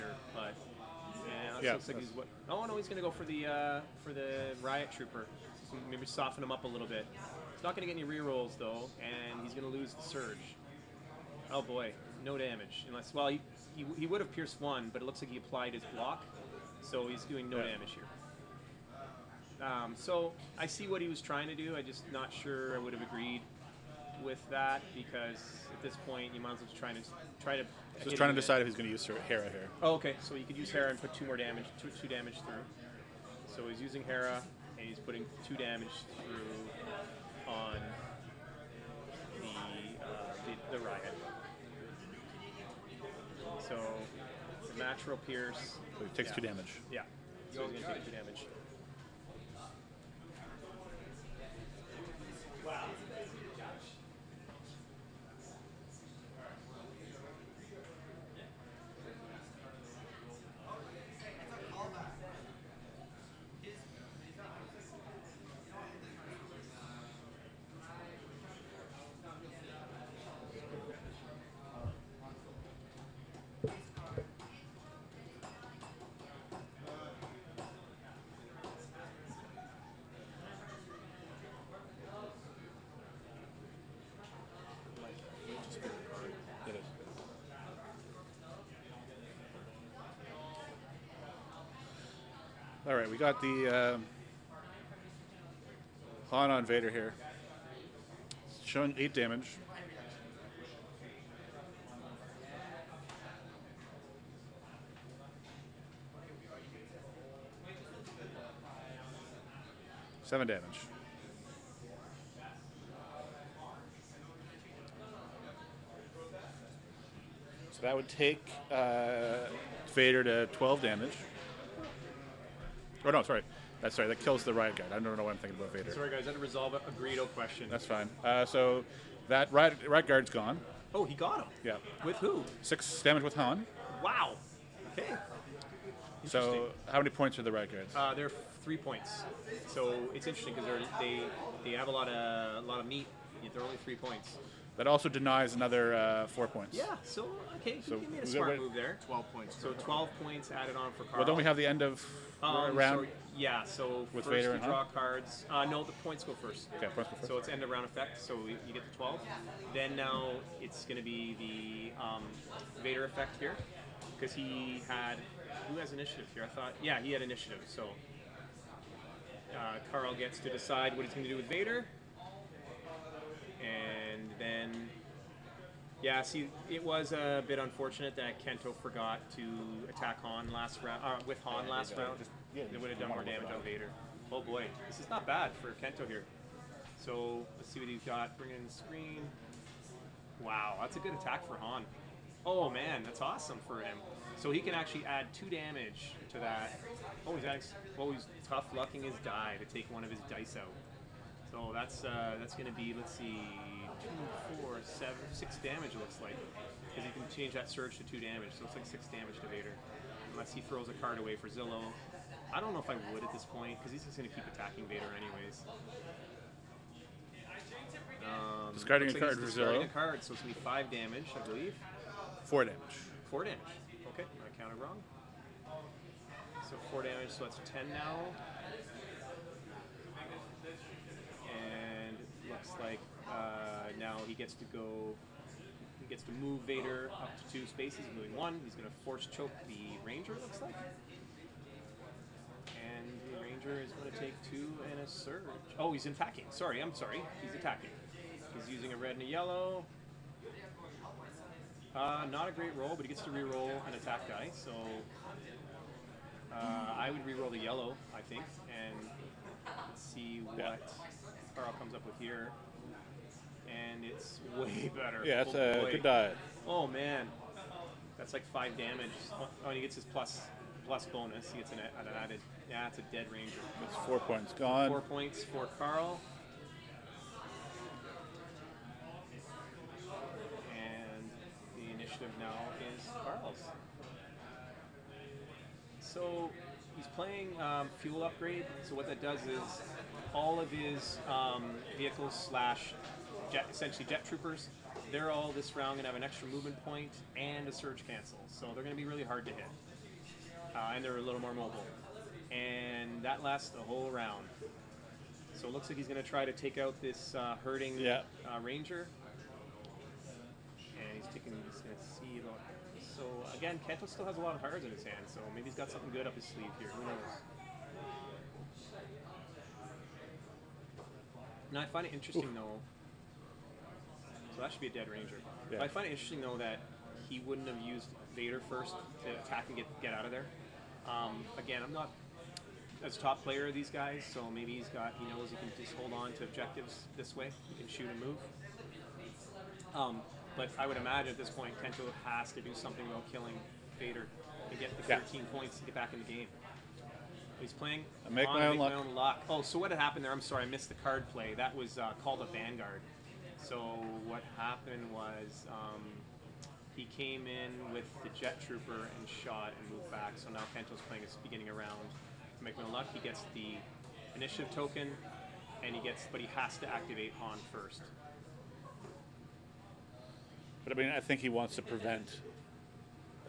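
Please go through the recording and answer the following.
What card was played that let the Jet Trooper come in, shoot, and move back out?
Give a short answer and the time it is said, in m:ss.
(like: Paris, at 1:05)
Vanguard, at 5:52.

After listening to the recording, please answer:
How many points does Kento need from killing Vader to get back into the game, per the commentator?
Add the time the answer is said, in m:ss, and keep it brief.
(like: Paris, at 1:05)
13, at 5:45.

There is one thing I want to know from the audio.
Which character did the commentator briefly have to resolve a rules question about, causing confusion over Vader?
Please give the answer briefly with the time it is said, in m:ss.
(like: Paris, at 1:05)
Greedo, at 2:06.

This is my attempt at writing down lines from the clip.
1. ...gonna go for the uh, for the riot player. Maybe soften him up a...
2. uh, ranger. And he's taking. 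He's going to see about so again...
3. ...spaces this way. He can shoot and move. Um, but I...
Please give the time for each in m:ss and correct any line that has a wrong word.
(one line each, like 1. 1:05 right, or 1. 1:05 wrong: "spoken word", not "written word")
1. 0:02 wrong: "trooper", not "player"
2. 5:08 right
3. 5:36 wrong: "objectives", not "spaces".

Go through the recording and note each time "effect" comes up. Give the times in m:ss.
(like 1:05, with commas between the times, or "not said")
2:37, 2:43.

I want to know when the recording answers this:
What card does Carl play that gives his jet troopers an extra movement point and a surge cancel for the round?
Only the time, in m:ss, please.
4:47.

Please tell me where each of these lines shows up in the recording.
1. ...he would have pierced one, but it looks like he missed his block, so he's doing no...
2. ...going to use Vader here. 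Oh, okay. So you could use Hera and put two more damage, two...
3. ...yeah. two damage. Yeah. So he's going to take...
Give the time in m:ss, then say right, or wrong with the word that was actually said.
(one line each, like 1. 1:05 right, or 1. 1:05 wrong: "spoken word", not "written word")
1. 0:13 wrong: "applied", not "missed"
2. 0:28 wrong: "Hera", not "Vader"
3. 0:46 right.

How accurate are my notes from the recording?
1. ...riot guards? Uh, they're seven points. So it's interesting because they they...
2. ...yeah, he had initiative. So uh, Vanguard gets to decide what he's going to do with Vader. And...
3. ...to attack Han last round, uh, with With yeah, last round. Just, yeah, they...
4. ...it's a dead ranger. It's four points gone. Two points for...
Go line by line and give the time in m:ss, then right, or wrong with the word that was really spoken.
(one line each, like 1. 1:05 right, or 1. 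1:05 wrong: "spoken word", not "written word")
1. 2:17 wrong: "three", not "seven"
2. 2:46 wrong: "Carl", not "Vanguard"
3. 2:59 wrong: "Han", not "With"
4. 4:32 wrong: "Four", not "Two".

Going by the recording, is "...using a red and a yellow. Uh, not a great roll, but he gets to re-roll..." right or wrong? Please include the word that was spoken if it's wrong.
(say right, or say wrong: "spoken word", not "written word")
right.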